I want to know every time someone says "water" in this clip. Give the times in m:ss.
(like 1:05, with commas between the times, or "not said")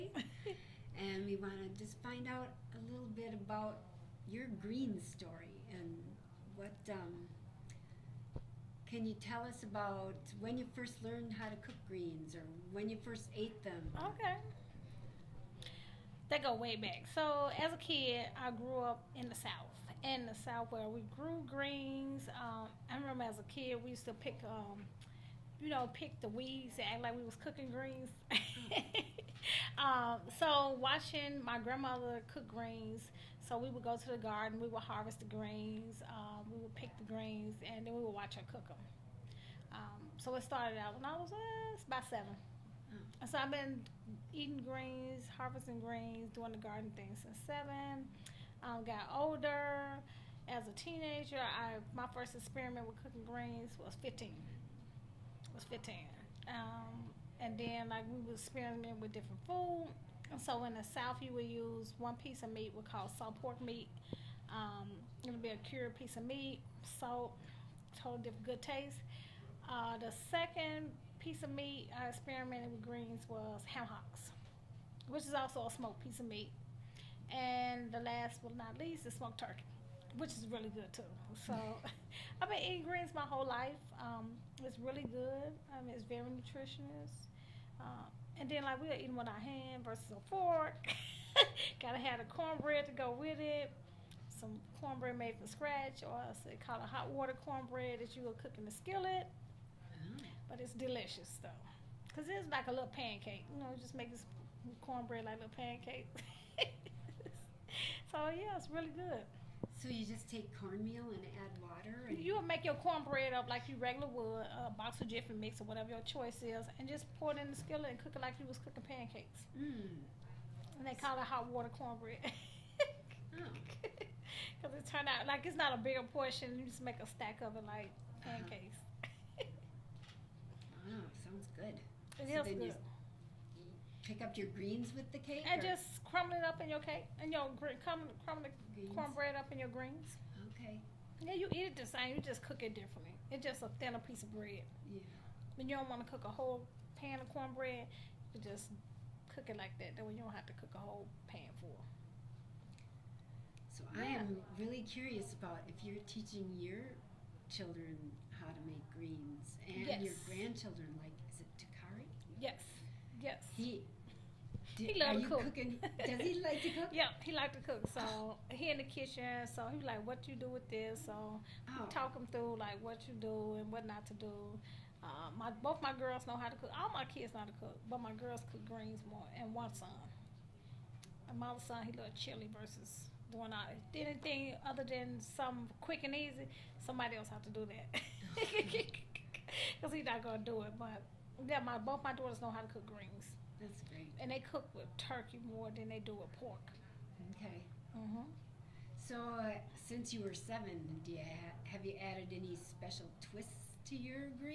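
1:37, 1:51, 2:01.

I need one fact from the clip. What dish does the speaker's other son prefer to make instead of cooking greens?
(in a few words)
Chili.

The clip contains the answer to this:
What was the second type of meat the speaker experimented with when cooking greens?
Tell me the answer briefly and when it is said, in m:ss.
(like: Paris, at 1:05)
Ham hocks, at 1:13.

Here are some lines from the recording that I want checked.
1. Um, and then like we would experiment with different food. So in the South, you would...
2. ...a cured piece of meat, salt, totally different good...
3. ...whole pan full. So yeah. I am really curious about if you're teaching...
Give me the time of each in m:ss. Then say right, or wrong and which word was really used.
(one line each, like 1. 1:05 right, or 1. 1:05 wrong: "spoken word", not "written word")
1. 0:56 right
2. 1:05 right
3. 2:30 right.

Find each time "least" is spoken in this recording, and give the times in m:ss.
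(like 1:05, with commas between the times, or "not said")
1:18.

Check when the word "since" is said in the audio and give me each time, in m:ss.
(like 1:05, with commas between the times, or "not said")
0:47, 3:19.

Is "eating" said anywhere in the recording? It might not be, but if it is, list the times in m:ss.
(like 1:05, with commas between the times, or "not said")
0:44, 1:22, 1:28.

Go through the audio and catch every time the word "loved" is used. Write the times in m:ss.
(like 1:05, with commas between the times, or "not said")
2:44, 3:01.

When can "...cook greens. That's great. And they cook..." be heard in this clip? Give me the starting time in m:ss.
3:12.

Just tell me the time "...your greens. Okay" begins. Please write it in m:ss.
2:19.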